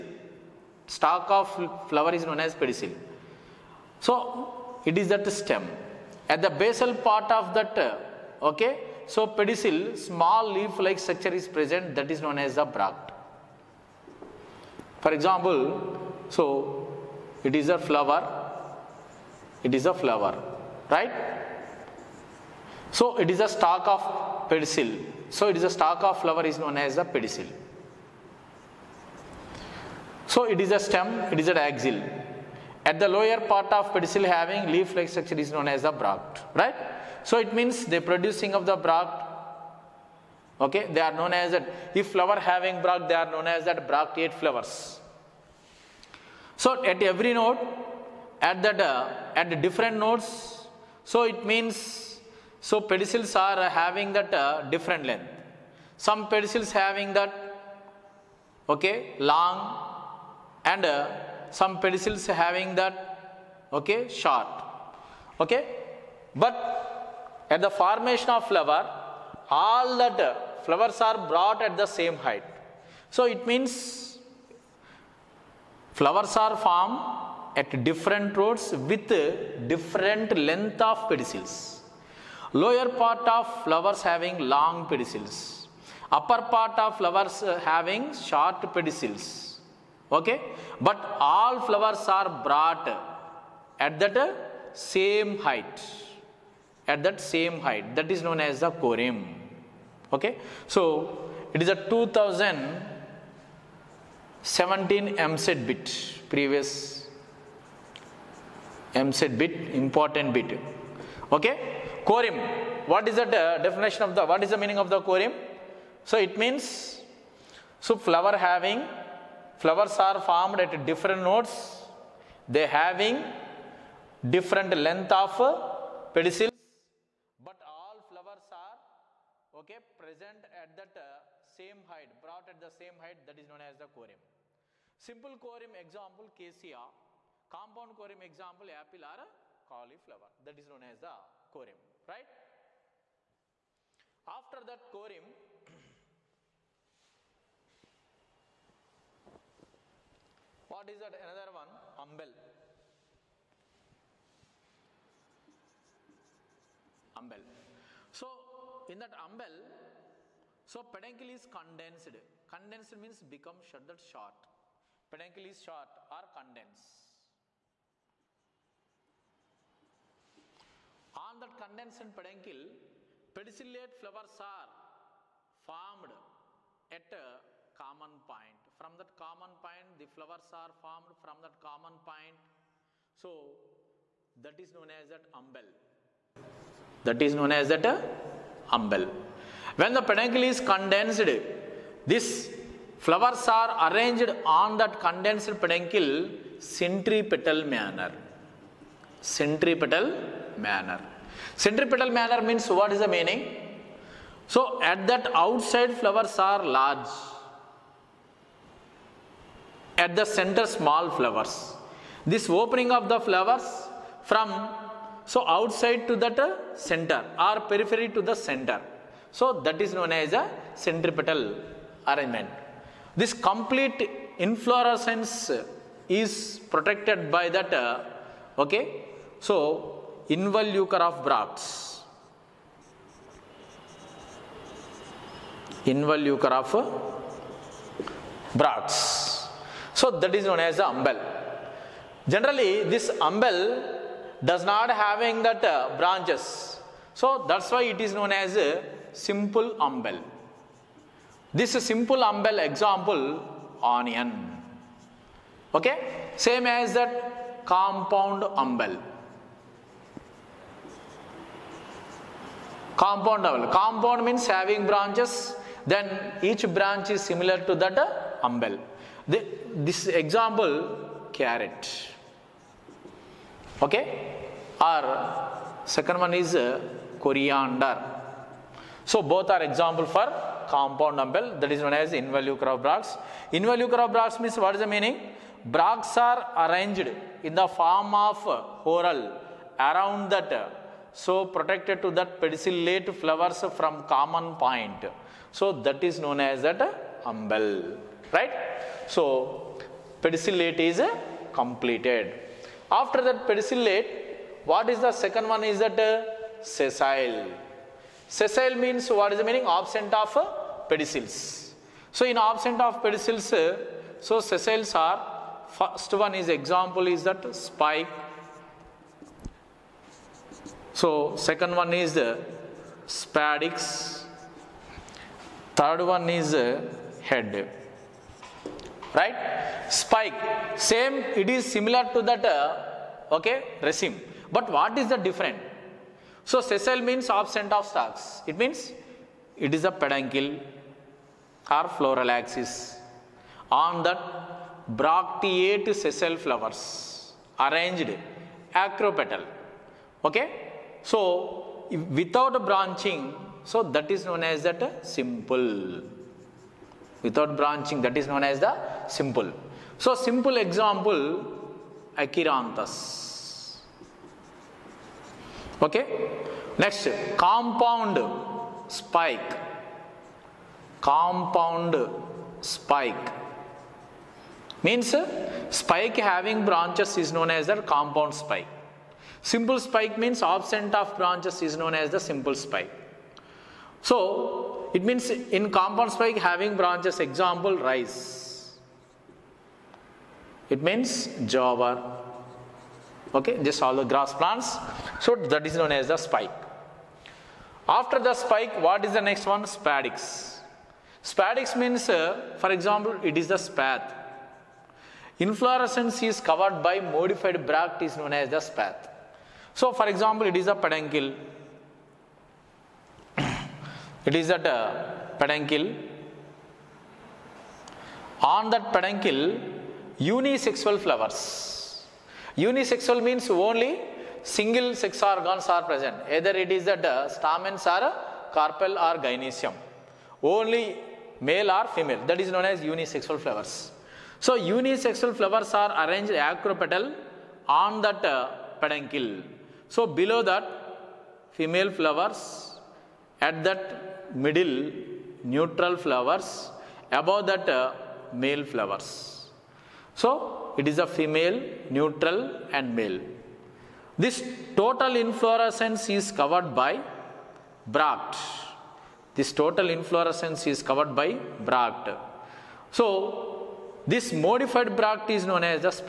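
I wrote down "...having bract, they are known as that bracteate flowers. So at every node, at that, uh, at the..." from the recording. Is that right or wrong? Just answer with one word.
right.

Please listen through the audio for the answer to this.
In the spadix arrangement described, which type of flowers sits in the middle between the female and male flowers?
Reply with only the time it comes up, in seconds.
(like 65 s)
445 s.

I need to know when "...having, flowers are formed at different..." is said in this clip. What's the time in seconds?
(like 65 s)
118 s.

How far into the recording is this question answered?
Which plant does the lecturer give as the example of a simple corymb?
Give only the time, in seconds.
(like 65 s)
136 s.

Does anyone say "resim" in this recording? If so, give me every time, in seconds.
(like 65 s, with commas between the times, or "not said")
333 s.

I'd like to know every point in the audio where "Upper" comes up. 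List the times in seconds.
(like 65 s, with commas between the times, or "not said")
86 s.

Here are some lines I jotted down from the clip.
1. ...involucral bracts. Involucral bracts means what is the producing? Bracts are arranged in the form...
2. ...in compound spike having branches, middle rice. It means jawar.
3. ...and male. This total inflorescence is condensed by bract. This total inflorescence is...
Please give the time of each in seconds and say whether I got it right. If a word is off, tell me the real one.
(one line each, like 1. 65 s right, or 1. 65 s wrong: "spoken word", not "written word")
1. 282 s wrong: "meaning", not "producing"
2. 385 s wrong: "example", not "middle"
3. 452 s wrong: "covered", not "condensed".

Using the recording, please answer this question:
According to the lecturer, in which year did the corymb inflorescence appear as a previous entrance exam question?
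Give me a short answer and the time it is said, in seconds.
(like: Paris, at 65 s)
2017, at 101 s.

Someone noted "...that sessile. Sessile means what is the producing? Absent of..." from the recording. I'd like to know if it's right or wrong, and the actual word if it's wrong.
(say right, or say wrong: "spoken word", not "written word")
wrong: "meaning", not "producing".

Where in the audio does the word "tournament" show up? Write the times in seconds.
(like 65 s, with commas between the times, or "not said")
not said.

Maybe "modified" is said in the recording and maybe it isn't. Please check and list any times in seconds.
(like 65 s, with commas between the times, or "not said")
407 s, 464 s.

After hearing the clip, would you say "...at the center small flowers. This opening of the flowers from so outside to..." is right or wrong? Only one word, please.
right.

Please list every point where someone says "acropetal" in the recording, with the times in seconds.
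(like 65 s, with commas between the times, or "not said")
348 s, 436 s.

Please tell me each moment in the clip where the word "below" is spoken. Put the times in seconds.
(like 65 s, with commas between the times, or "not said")
440 s.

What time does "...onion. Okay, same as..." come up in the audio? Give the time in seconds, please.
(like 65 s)
253 s.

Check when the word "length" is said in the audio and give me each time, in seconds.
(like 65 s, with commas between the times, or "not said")
55 s, 80 s, 124 s.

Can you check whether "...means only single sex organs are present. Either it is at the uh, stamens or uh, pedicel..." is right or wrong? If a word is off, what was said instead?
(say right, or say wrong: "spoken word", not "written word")
wrong: "carpel", not "pedicel".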